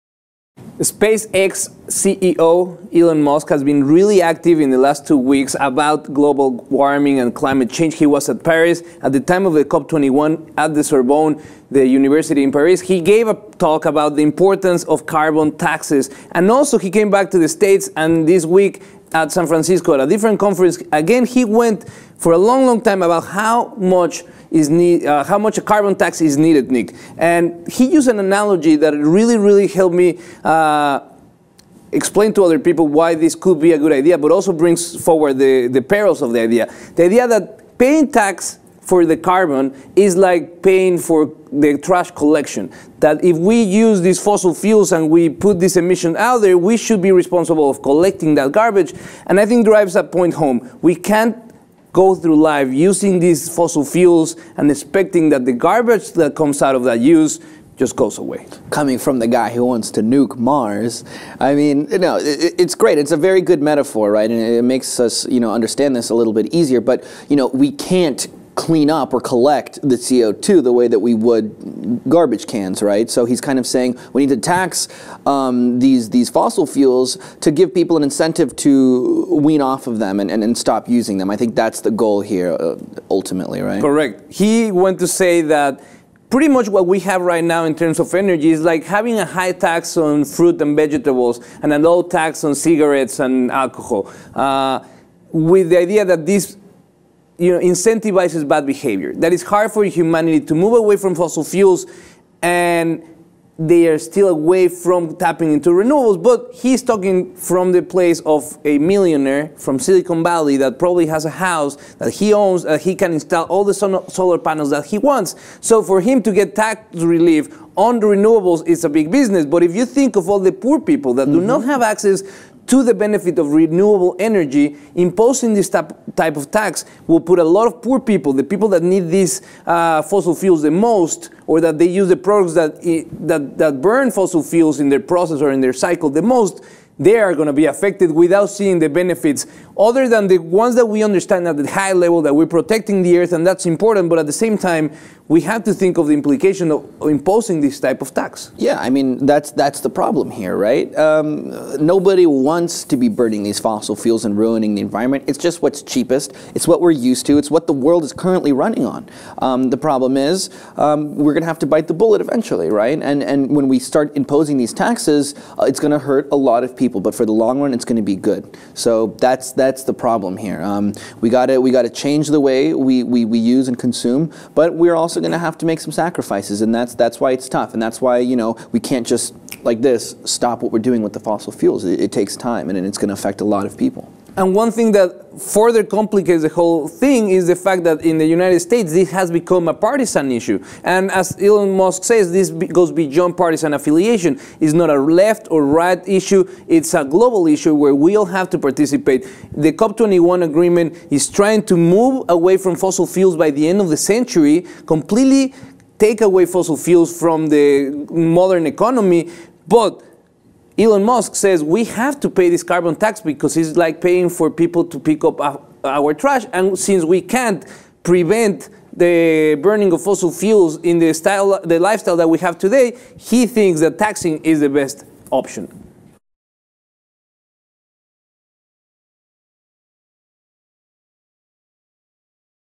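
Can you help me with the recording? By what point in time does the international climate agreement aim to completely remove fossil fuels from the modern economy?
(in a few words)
End of the century.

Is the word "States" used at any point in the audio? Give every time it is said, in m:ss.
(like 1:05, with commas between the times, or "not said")
0:17, 3:08.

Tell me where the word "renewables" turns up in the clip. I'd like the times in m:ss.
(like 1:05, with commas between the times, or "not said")
1:45, 1:58, 2:03.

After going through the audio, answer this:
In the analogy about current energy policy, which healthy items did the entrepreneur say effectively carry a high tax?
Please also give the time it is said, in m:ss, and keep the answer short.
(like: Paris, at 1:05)
Fruit and vegetables, at 1:30.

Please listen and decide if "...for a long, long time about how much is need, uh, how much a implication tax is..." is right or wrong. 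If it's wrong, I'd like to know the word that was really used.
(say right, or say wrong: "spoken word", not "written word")
wrong: "carbon", not "implication".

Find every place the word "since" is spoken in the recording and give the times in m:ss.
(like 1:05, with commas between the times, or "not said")
3:36.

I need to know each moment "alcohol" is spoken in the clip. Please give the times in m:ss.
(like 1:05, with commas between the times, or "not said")
1:33.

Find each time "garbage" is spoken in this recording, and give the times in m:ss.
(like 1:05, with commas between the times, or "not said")
0:48, 0:55, 1:12.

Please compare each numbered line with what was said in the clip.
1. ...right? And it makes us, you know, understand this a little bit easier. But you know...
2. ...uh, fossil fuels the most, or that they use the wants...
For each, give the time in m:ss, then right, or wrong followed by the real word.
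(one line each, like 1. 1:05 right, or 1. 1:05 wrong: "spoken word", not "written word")
1. 1:04 right
2. 2:09 wrong: "products", not "wants".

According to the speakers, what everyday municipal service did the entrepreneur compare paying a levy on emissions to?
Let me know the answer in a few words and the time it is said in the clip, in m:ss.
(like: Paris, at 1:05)
Trash collection, at 0:41.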